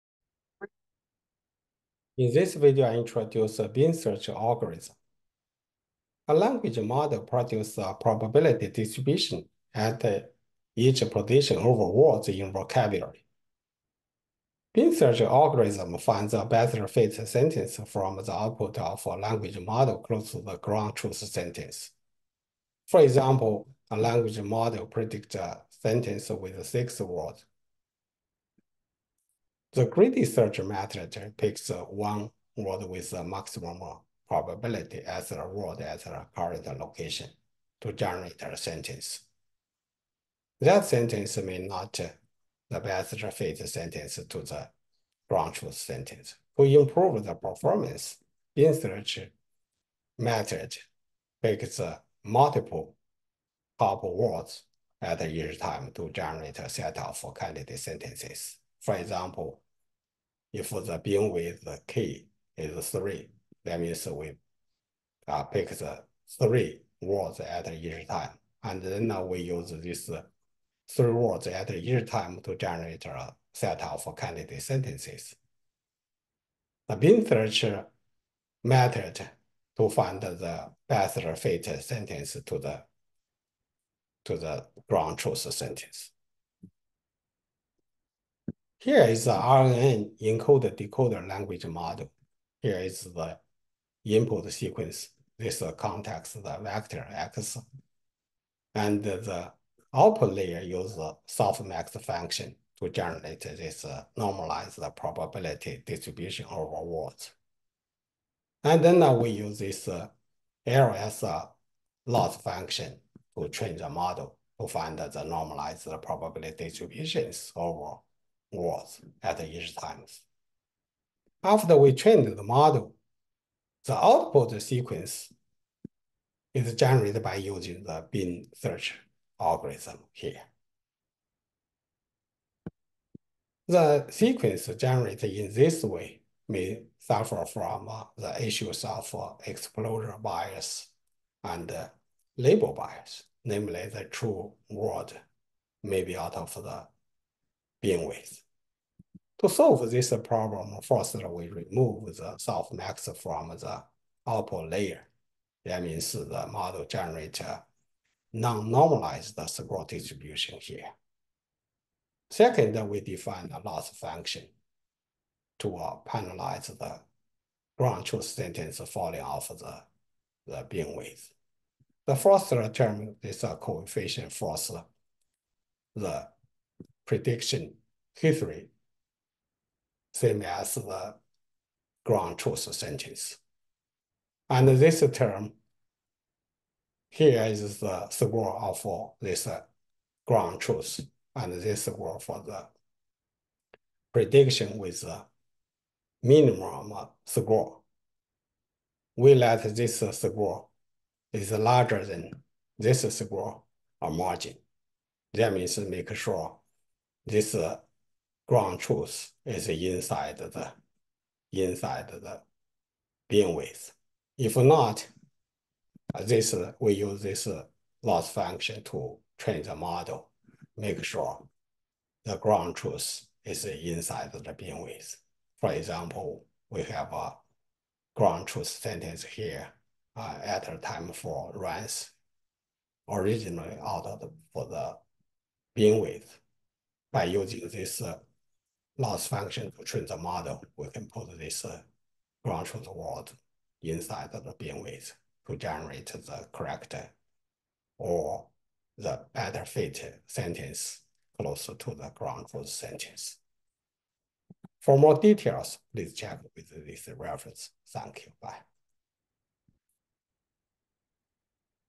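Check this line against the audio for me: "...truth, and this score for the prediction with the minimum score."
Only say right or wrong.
right.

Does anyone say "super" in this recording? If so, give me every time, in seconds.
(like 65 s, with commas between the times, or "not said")
not said.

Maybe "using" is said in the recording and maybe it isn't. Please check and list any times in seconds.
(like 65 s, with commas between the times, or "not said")
127 s, 237 s.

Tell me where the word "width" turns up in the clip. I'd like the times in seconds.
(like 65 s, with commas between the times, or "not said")
147 s, 170 s, 213 s, 224 s, 235 s, 244 s.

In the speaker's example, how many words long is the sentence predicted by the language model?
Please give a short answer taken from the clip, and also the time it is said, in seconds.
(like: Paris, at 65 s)
6, at 26 s.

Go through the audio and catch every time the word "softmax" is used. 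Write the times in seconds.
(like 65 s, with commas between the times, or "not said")
101 s, 152 s.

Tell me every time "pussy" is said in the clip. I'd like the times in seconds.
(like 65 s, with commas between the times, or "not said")
not said.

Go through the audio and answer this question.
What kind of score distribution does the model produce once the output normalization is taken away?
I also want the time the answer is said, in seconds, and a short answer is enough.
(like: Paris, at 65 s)
non-normalized, at 158 s.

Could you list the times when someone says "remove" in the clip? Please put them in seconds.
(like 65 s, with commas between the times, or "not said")
151 s.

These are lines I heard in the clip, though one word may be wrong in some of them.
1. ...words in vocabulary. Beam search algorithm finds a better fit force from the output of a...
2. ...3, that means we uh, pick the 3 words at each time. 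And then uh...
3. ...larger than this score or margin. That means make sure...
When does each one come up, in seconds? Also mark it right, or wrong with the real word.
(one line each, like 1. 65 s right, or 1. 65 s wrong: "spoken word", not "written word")
1. 11 s wrong: "sentence", not "force"
2. 62 s right
3. 201 s right.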